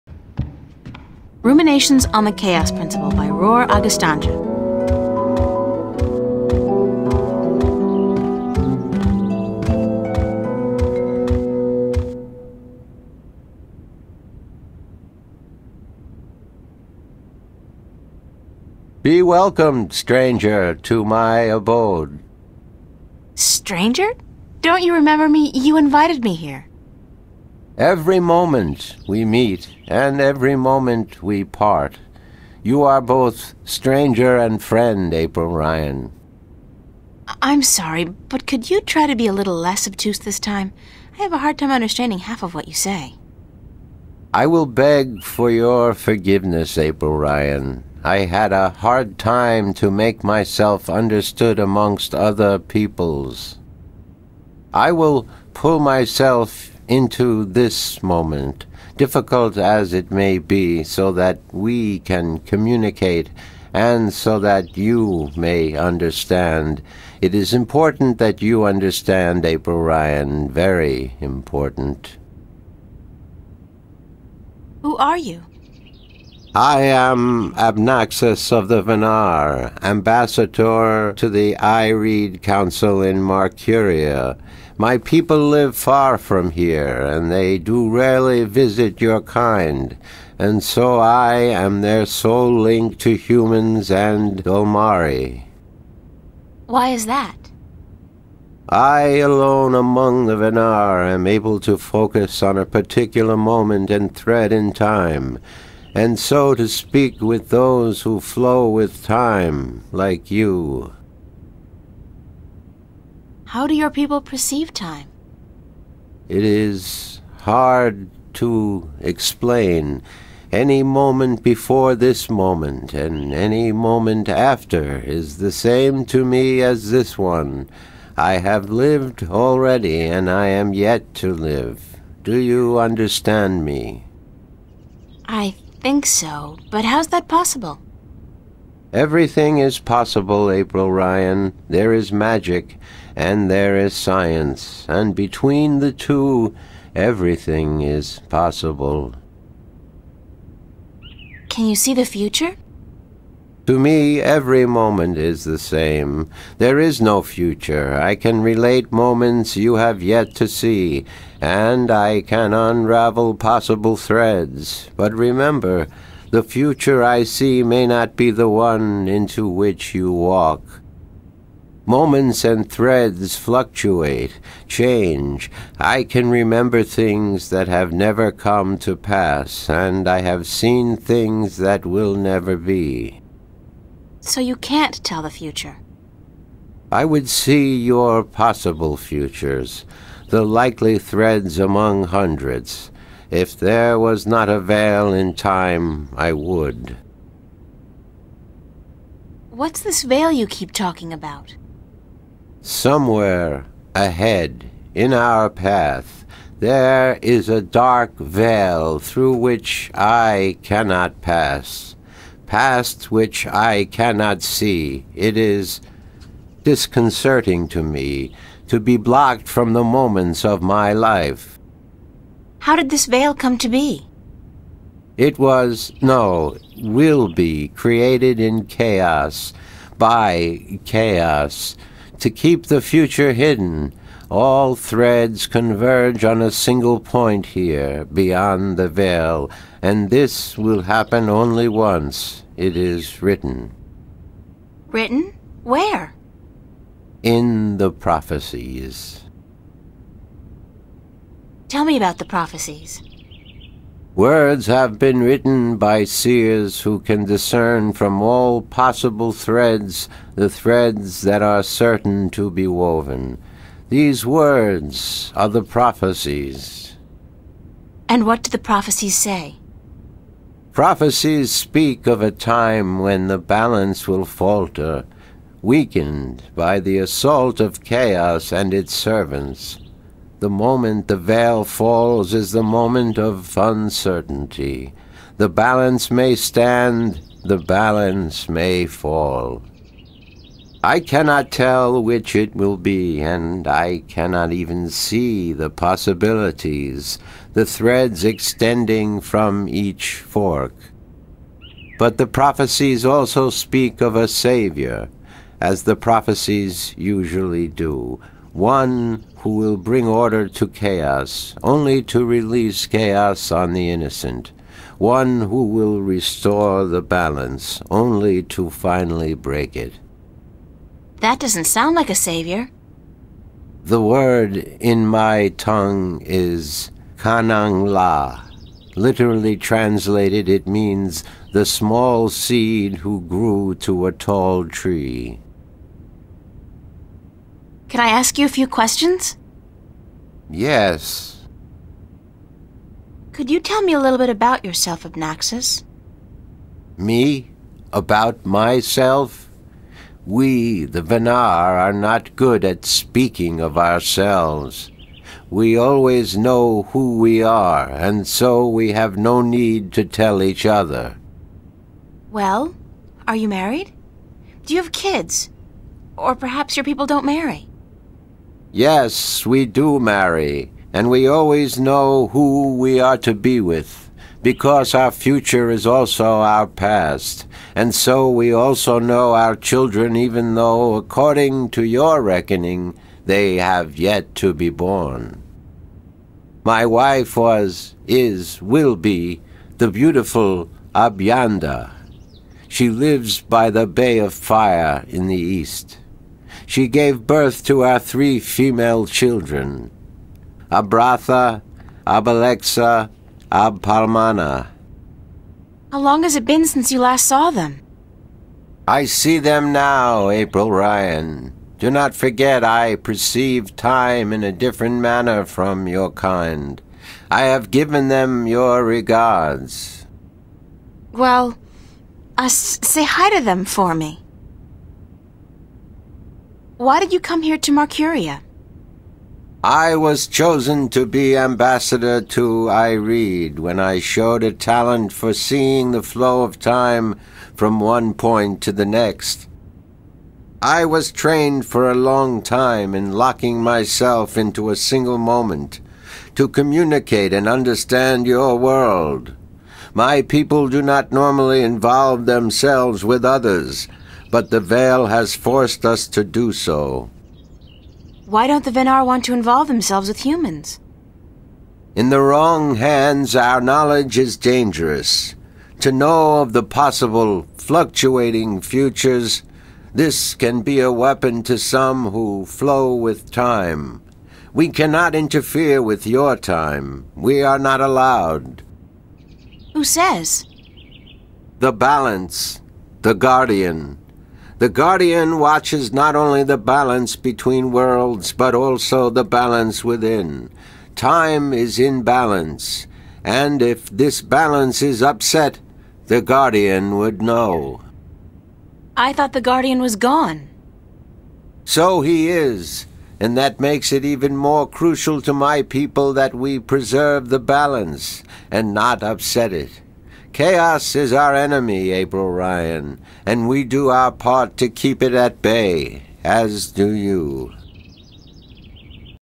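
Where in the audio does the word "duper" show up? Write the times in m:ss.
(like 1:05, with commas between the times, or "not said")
not said.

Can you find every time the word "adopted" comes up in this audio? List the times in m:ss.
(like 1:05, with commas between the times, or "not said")
not said.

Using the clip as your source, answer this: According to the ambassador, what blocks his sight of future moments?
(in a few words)
a dark veil.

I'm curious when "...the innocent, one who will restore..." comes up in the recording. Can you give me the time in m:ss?
5:13.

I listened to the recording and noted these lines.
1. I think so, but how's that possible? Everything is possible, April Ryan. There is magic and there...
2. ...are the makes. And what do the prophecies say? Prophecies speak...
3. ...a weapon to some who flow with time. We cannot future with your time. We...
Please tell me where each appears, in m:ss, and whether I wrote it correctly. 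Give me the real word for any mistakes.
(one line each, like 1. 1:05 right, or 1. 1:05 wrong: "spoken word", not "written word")
1. 2:15 right
2. 4:25 wrong: "prophecies", not "makes"
3. 7:50 wrong: "interfere", not "future".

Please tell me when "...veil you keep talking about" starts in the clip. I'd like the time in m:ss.
3:20.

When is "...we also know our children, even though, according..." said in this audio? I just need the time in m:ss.
6:18.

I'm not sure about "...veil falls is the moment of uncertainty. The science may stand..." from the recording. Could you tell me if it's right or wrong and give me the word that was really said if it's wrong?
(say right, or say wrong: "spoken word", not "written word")
wrong: "balance", not "science".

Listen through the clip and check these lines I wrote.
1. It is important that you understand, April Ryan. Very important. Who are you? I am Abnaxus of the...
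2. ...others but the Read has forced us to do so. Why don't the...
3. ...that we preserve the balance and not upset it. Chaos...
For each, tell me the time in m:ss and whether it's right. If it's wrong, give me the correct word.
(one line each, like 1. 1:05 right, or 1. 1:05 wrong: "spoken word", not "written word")
1. 1:07 right
2. 7:33 wrong: "Veil", not "Read"
3. 8:26 right.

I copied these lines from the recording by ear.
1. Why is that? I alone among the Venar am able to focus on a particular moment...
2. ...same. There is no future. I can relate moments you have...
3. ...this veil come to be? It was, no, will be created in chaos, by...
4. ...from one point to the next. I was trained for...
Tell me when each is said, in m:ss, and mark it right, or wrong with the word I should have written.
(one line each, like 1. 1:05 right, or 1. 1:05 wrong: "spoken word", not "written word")
1. 1:36 right
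2. 2:35 right
3. 3:42 right
4. 7:17 right.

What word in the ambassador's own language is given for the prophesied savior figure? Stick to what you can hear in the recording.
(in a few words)
Kanang La.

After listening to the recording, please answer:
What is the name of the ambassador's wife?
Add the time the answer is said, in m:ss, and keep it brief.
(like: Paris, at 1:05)
Abyanda, at 6:30.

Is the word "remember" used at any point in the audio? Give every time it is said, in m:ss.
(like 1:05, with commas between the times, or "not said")
0:24, 2:45, 2:56.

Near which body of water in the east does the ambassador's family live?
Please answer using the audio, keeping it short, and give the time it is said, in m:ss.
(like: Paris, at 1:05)
Bay of Fire, at 6:33.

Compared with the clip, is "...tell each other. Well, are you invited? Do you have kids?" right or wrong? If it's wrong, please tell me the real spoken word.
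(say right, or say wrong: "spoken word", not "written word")
wrong: "married", not "invited".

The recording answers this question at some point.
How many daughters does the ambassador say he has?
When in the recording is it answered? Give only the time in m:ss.
6:37.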